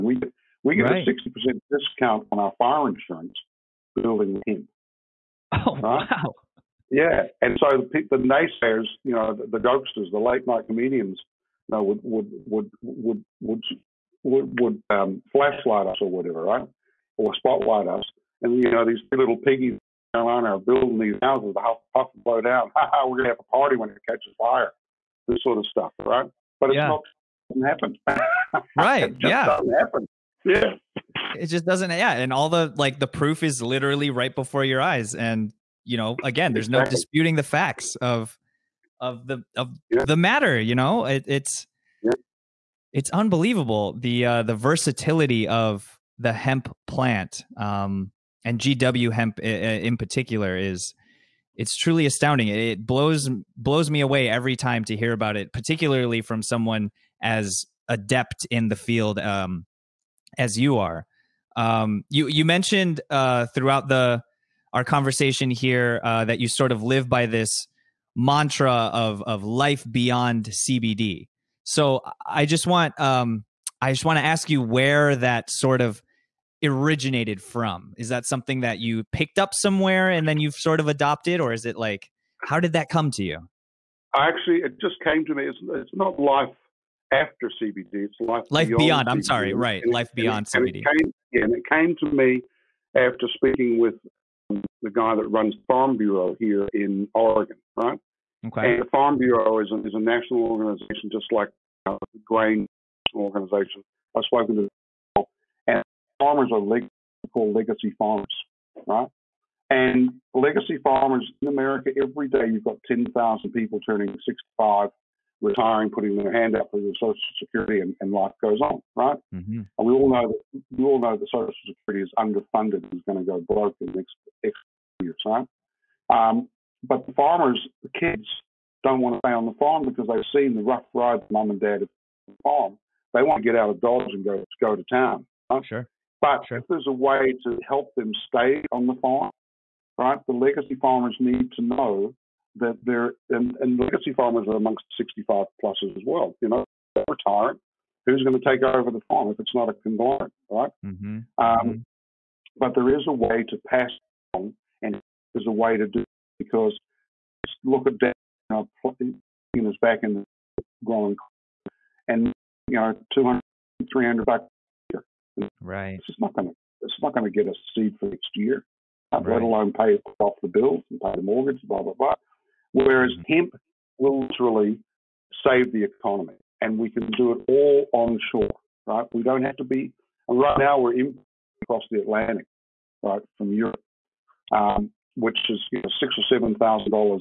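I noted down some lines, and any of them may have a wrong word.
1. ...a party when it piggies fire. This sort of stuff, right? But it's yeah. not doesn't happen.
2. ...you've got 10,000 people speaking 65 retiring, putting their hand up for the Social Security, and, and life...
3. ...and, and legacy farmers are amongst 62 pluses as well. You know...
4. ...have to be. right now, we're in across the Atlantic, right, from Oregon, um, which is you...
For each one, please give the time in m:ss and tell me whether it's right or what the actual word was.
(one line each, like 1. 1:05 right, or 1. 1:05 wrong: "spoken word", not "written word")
1. 0:23 wrong: "catches", not "piggies"
2. 1:52 wrong: "turning", not "speaking"
3. 2:23 wrong: "65", not "62"
4. 2:59 wrong: "Europe", not "Oregon".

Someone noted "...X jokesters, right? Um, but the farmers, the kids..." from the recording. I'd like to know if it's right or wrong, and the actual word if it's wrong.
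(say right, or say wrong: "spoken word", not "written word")
wrong: "years", not "jokesters".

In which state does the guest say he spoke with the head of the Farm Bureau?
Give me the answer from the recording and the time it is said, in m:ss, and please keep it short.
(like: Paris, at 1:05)
Oregon, at 1:37.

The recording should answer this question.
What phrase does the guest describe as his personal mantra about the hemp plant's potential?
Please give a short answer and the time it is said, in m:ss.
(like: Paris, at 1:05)
life beyond CBD, at 1:29.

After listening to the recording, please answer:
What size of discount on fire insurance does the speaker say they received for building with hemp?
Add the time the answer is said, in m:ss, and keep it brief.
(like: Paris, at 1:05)
60%, at 0:01.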